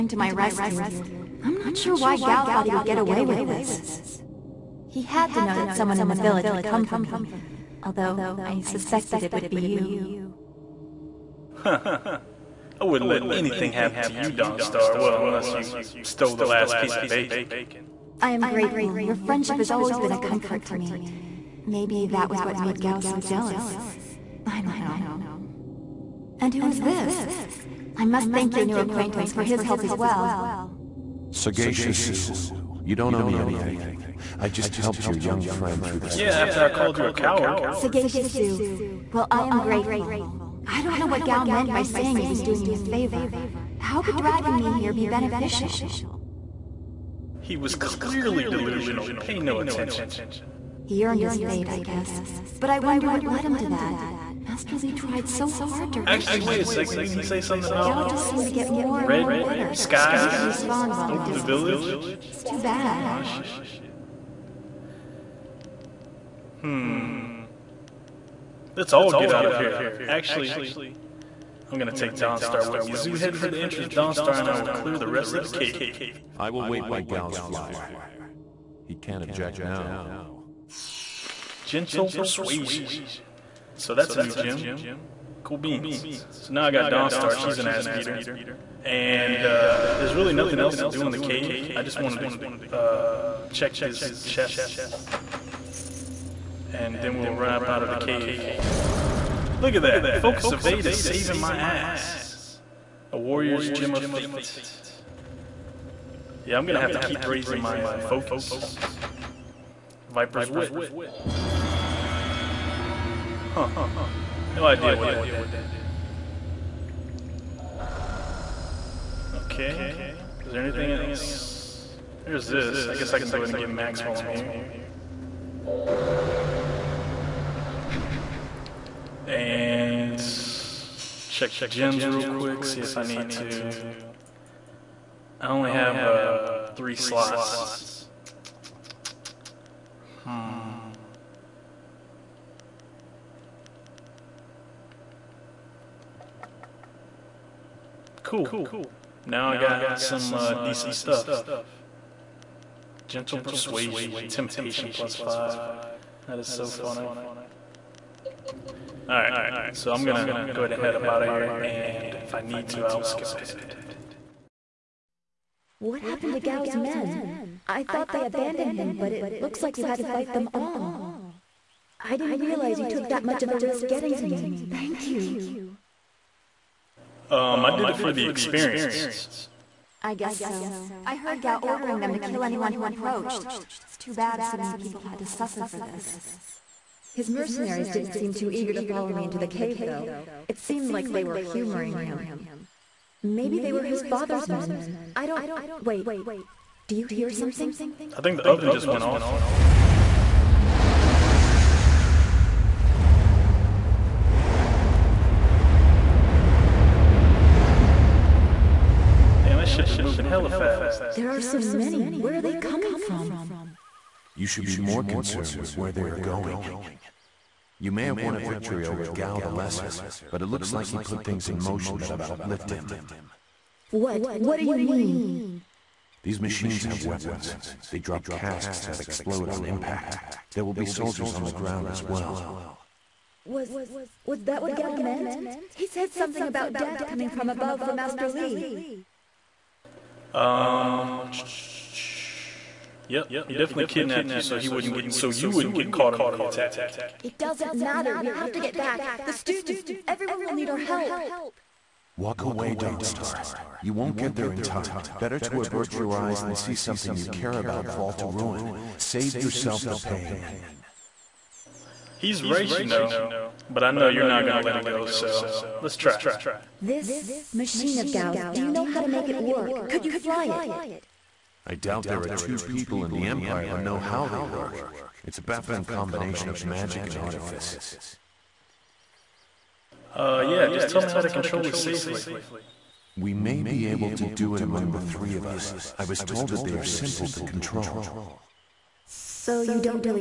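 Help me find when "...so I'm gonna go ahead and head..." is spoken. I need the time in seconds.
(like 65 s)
159 s.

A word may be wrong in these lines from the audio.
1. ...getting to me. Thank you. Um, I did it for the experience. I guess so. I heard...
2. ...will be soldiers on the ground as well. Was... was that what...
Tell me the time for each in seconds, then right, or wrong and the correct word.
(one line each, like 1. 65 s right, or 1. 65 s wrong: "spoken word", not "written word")
1. 173 s right
2. 230 s right.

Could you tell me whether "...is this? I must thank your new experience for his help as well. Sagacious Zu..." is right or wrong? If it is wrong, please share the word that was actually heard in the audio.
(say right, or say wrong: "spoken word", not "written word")
wrong: "acquaintance", not "experience".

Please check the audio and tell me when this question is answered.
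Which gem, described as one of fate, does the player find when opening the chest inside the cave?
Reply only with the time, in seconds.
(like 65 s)
103 s.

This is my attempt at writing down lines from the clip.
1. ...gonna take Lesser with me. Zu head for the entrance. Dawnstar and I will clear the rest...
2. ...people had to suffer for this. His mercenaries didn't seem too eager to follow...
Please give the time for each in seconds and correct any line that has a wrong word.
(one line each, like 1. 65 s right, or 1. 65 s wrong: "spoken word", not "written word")
1. 71 s wrong: "Dawnstar", not "Lesser"
2. 184 s right.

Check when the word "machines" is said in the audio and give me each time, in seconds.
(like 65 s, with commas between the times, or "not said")
226 s, 267 s.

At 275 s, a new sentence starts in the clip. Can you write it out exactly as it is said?
It's a baffling combination of magic and artifice.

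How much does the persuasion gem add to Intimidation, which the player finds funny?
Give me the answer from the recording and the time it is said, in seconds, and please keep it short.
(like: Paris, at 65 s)
5, at 155 s.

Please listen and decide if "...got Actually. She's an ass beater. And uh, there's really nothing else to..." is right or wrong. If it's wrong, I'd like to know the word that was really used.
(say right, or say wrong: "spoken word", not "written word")
wrong: "Dawnstar", not "Actually".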